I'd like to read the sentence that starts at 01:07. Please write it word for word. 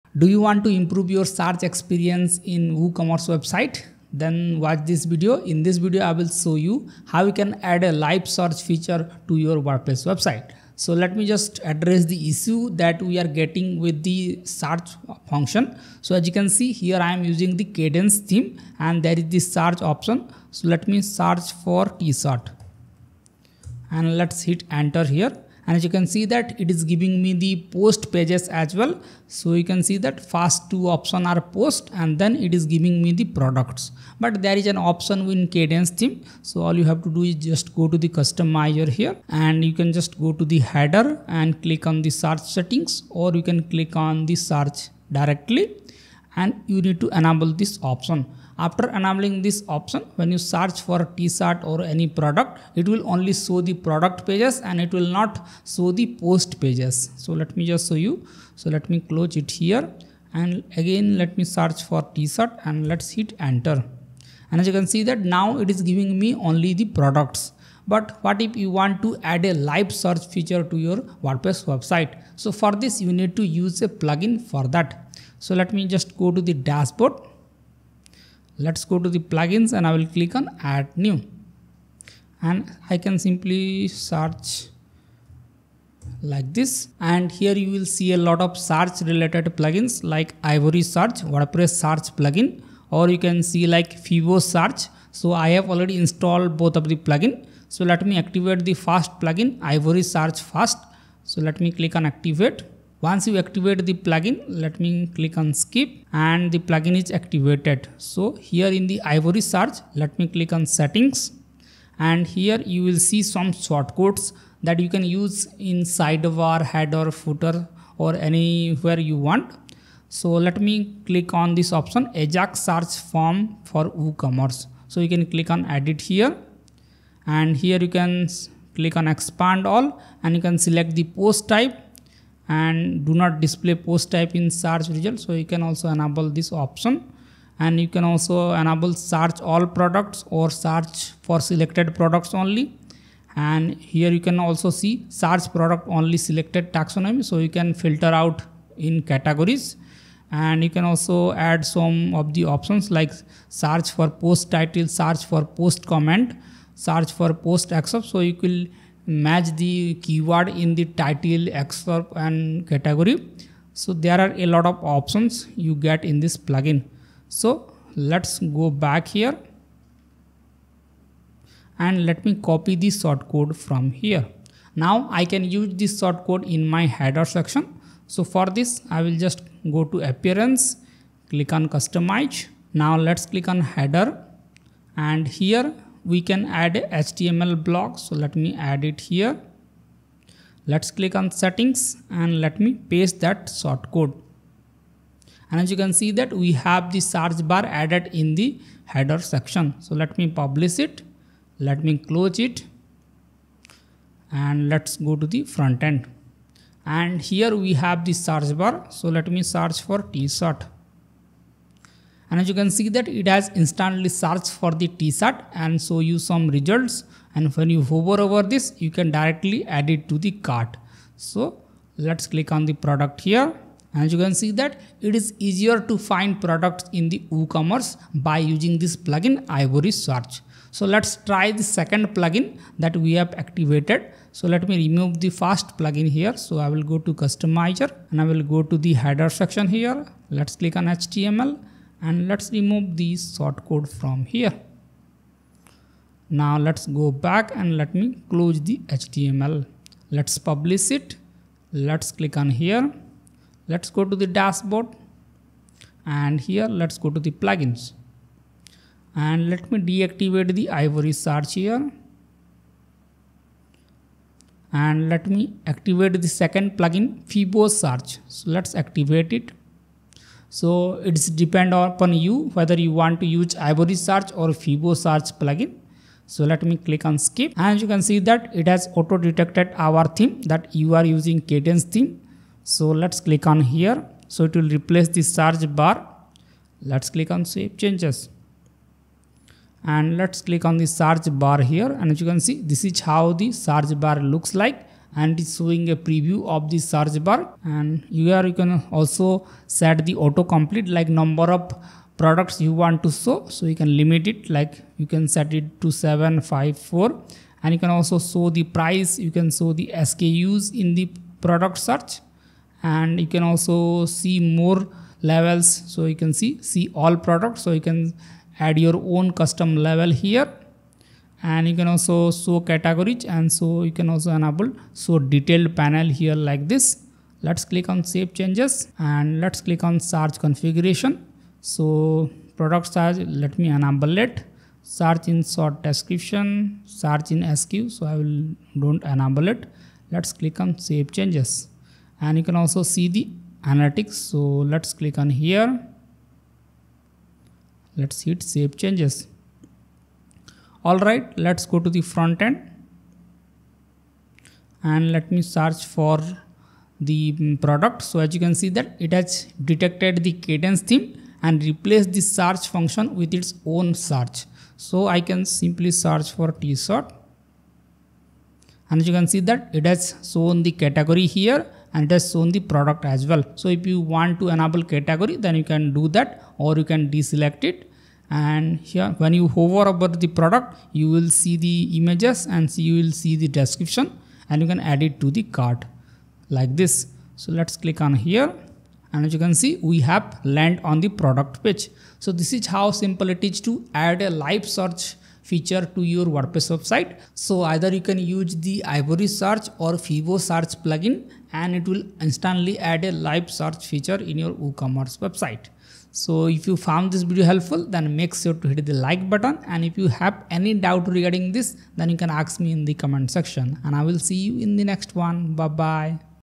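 But what if you want to add a live search feature to your WordPress website?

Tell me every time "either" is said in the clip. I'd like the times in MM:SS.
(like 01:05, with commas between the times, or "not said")
06:37.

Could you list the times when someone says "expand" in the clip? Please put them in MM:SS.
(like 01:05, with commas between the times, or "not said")
02:09.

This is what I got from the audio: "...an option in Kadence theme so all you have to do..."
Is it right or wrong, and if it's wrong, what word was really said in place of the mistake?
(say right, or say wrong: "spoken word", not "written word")
right.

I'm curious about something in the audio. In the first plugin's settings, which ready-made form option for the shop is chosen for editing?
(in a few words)
Ajax search form for WooCommerce.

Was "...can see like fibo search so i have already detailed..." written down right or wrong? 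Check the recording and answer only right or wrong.
wrong.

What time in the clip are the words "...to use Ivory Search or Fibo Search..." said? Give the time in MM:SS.
04:33.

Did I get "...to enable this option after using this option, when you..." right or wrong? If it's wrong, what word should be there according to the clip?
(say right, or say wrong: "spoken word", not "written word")
wrong: "enabling", not "using".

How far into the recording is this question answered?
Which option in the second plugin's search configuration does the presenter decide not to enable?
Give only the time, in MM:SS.
05:36.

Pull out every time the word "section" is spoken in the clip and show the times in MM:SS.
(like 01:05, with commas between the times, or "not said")
02:57, 03:19, 03:59, 06:53.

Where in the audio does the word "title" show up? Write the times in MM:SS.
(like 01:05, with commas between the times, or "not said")
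02:34, 02:40.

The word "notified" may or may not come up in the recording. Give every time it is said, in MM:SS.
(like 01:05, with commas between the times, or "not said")
not said.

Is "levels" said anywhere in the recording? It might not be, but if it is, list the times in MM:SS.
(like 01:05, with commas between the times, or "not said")
05:15, 05:19.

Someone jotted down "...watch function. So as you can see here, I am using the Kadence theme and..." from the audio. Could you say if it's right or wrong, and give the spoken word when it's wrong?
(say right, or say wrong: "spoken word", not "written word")
wrong: "search", not "watch".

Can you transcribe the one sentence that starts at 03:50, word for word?
So let's try the second plugin that we have activated.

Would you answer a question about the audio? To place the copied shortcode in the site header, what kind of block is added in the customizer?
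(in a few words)
HTML block.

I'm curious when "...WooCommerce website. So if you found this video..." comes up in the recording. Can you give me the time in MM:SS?
06:44.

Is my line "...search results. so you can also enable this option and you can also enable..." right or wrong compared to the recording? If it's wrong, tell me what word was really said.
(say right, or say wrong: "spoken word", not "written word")
right.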